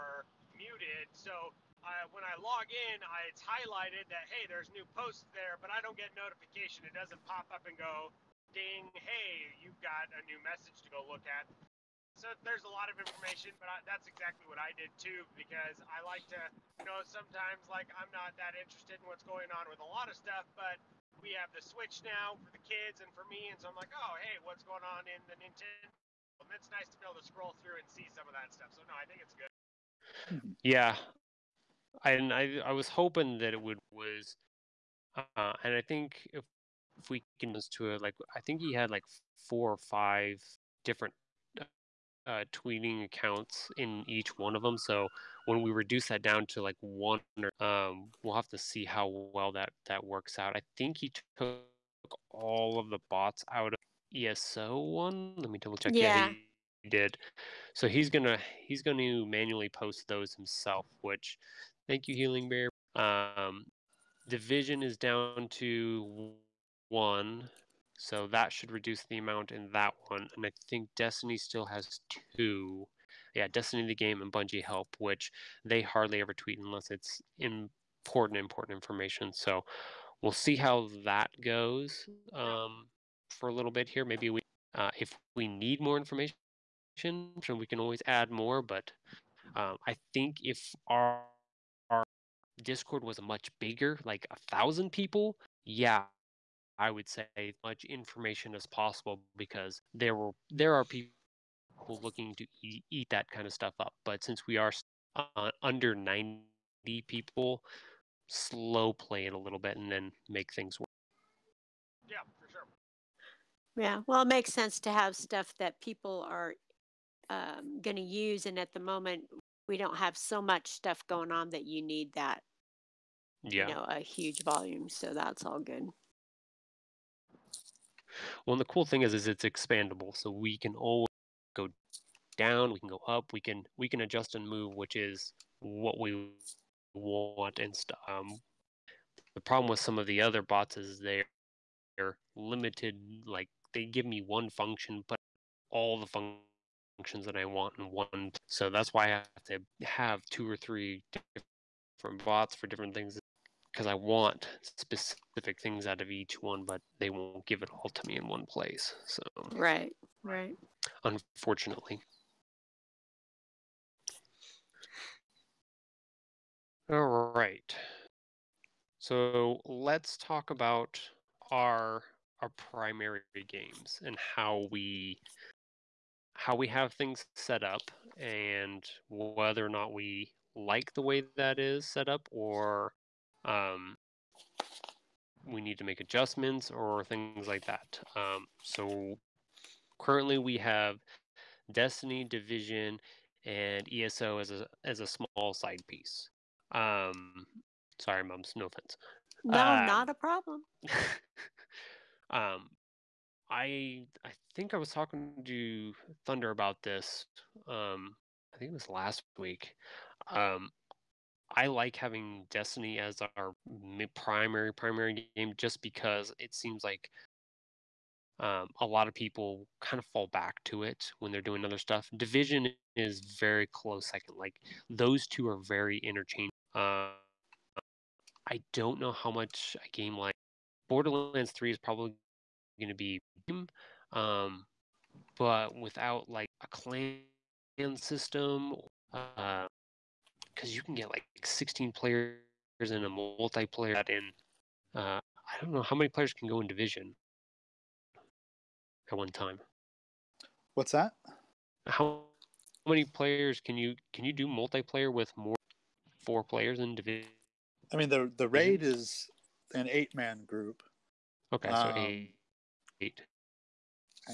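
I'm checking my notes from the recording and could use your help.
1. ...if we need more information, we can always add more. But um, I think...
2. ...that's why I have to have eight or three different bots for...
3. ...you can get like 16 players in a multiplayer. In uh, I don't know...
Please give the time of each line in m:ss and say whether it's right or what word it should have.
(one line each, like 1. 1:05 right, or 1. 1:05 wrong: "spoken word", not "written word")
1. 1:24 right
2. 2:28 wrong: "two", not "eight"
3. 4:00 right.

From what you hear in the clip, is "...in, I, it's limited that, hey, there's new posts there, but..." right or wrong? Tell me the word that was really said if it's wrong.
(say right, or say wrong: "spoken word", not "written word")
wrong: "highlighted", not "limited".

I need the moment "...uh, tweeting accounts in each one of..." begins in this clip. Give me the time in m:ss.
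0:42.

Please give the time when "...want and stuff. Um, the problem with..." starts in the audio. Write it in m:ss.
2:16.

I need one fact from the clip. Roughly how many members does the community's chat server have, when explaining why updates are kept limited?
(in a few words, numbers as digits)
under 90.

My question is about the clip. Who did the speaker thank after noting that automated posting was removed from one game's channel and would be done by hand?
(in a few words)
Healing Bear.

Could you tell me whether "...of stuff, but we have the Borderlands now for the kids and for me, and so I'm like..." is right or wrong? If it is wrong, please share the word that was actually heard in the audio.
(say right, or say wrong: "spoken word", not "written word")
wrong: "Switch", not "Borderlands".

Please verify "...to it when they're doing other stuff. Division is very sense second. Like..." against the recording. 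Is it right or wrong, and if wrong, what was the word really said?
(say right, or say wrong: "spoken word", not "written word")
wrong: "close", not "sense".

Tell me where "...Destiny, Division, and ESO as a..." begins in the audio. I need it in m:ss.
3:11.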